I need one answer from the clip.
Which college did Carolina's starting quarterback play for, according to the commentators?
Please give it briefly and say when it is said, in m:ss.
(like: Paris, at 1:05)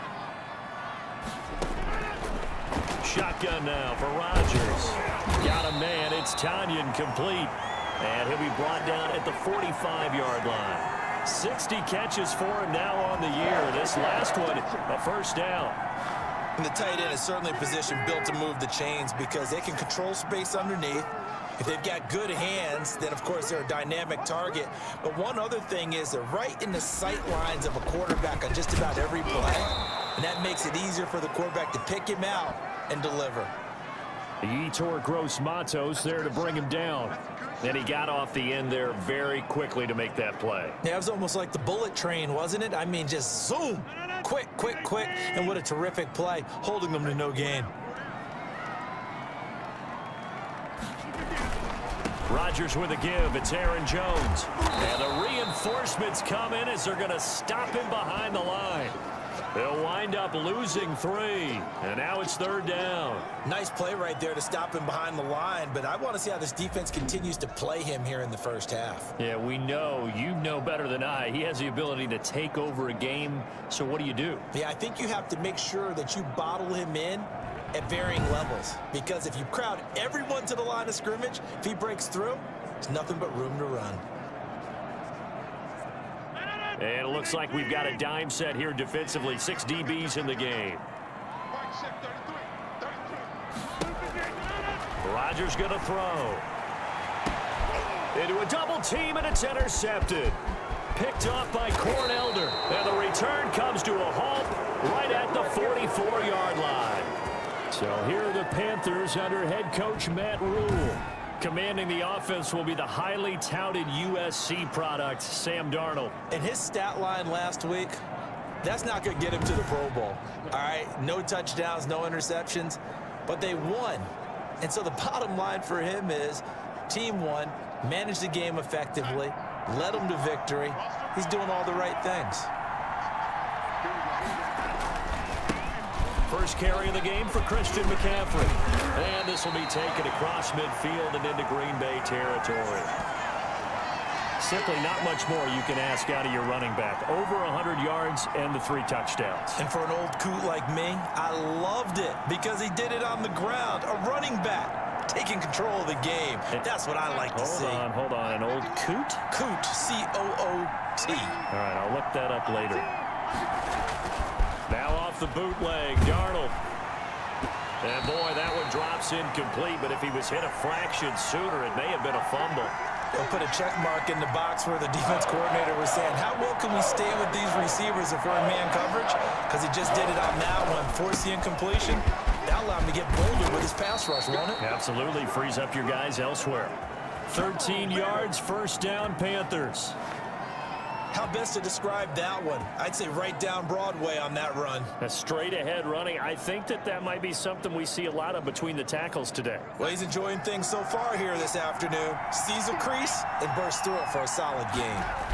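USC, at 1:53.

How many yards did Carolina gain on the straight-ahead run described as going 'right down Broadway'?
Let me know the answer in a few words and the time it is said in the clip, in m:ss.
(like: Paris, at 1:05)
13, at 3:07.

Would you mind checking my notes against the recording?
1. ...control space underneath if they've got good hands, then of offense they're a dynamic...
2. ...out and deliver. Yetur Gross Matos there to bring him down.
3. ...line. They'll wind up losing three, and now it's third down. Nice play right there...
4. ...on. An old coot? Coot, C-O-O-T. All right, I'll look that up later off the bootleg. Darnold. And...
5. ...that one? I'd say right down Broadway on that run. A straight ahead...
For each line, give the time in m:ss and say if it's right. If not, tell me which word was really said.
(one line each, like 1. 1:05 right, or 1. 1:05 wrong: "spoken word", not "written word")
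1. 0:19 wrong: "course", not "offense"
2. 0:32 right
3. 0:58 right
4. 2:38 right
5. 3:12 right.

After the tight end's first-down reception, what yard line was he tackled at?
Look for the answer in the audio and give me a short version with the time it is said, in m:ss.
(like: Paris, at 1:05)
45, at 0:09.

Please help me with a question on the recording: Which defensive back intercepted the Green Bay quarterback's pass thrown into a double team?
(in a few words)
Corn Elder.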